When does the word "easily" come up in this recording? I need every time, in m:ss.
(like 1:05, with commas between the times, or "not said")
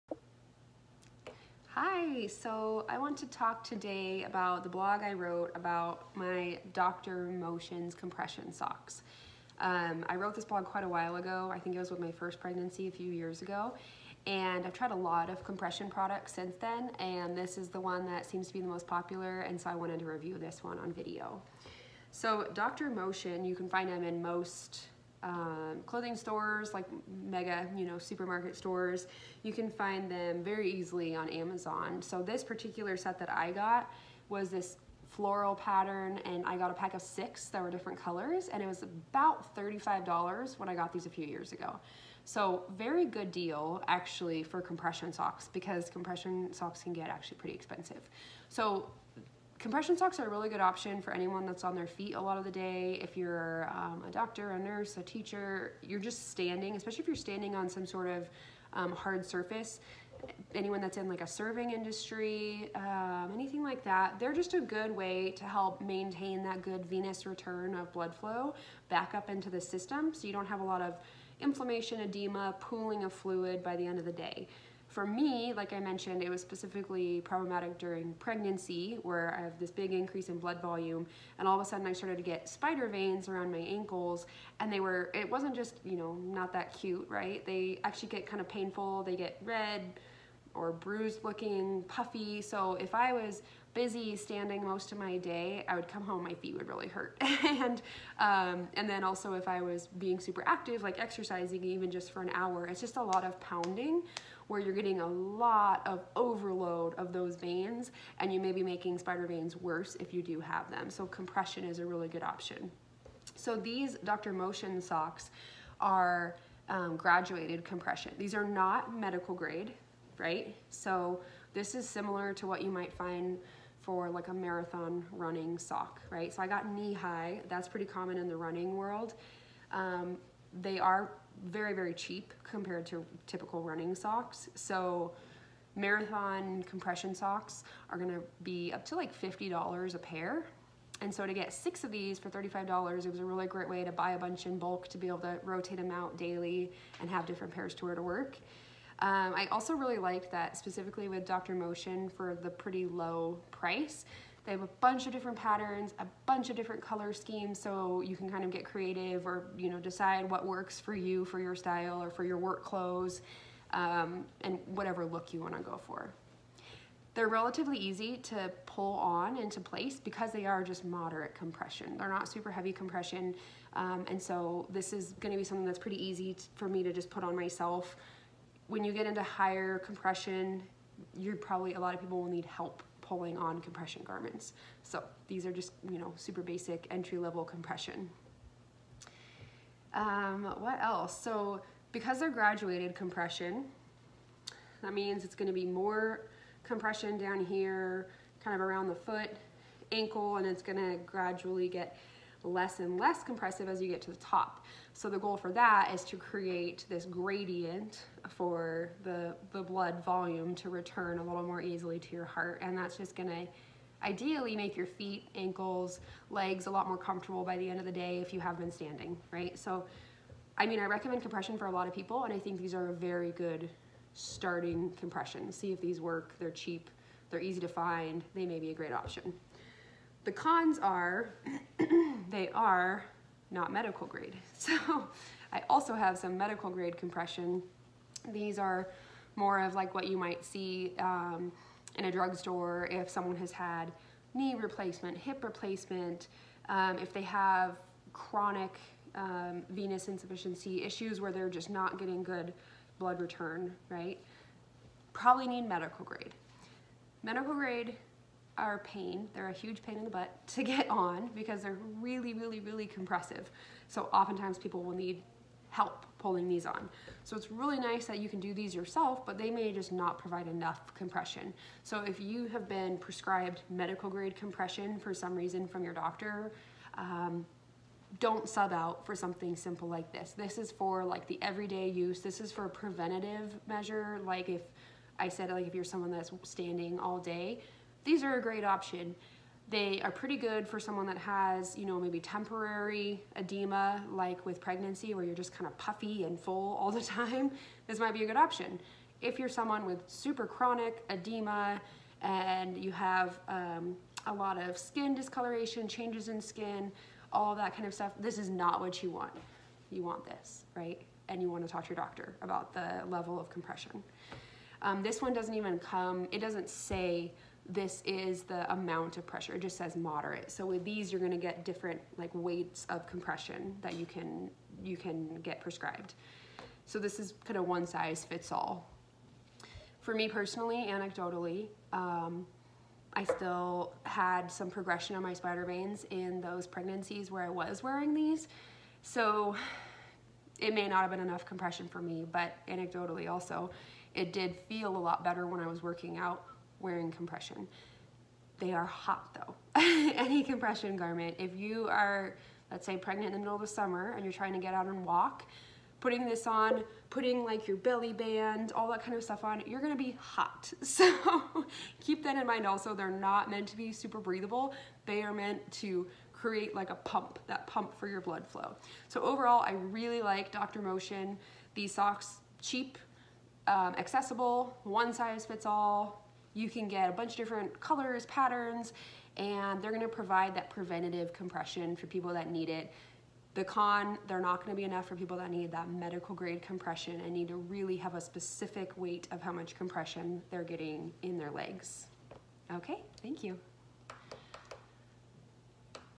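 0:30, 3:31.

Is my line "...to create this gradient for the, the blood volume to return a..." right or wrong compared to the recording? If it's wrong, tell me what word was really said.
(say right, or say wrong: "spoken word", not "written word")
right.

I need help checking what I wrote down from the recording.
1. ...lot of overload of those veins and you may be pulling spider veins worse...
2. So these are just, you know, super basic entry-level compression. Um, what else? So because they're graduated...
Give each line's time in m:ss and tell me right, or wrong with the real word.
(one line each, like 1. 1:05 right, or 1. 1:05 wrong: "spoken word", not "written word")
1. 1:45 wrong: "making", not "pulling"
2. 3:04 right.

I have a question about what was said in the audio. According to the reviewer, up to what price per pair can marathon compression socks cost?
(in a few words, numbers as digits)
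$50.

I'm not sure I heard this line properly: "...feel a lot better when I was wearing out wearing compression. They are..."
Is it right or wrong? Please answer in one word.
wrong.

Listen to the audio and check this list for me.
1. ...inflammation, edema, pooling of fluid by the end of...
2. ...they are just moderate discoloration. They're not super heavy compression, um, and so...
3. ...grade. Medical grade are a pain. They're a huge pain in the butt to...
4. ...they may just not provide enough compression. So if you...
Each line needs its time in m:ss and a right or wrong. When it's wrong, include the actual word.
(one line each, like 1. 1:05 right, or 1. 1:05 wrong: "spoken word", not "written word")
1. 1:11 right
2. 2:50 wrong: "compression", not "discoloration"
3. 4:16 right
4. 4:29 right.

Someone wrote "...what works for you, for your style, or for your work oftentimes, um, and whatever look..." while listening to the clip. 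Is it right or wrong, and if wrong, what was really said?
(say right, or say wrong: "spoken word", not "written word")
wrong: "clothes", not "oftentimes".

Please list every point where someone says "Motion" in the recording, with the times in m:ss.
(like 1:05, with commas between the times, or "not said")
0:07, 0:22, 1:54, 2:31, 6:10.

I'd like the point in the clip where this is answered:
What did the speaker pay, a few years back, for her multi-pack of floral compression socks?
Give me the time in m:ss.
0:38.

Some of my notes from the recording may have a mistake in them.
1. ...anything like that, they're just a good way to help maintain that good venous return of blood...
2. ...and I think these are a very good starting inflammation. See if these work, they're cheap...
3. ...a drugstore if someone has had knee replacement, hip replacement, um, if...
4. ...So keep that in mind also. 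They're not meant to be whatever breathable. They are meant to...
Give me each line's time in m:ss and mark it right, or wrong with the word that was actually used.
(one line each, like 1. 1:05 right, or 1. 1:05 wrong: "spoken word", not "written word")
1. 1:03 right
2. 3:42 wrong: "compression", not "inflammation"
3. 4:02 right
4. 6:00 wrong: "super", not "whatever".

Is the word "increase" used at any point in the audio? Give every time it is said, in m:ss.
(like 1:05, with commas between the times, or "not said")
1:19.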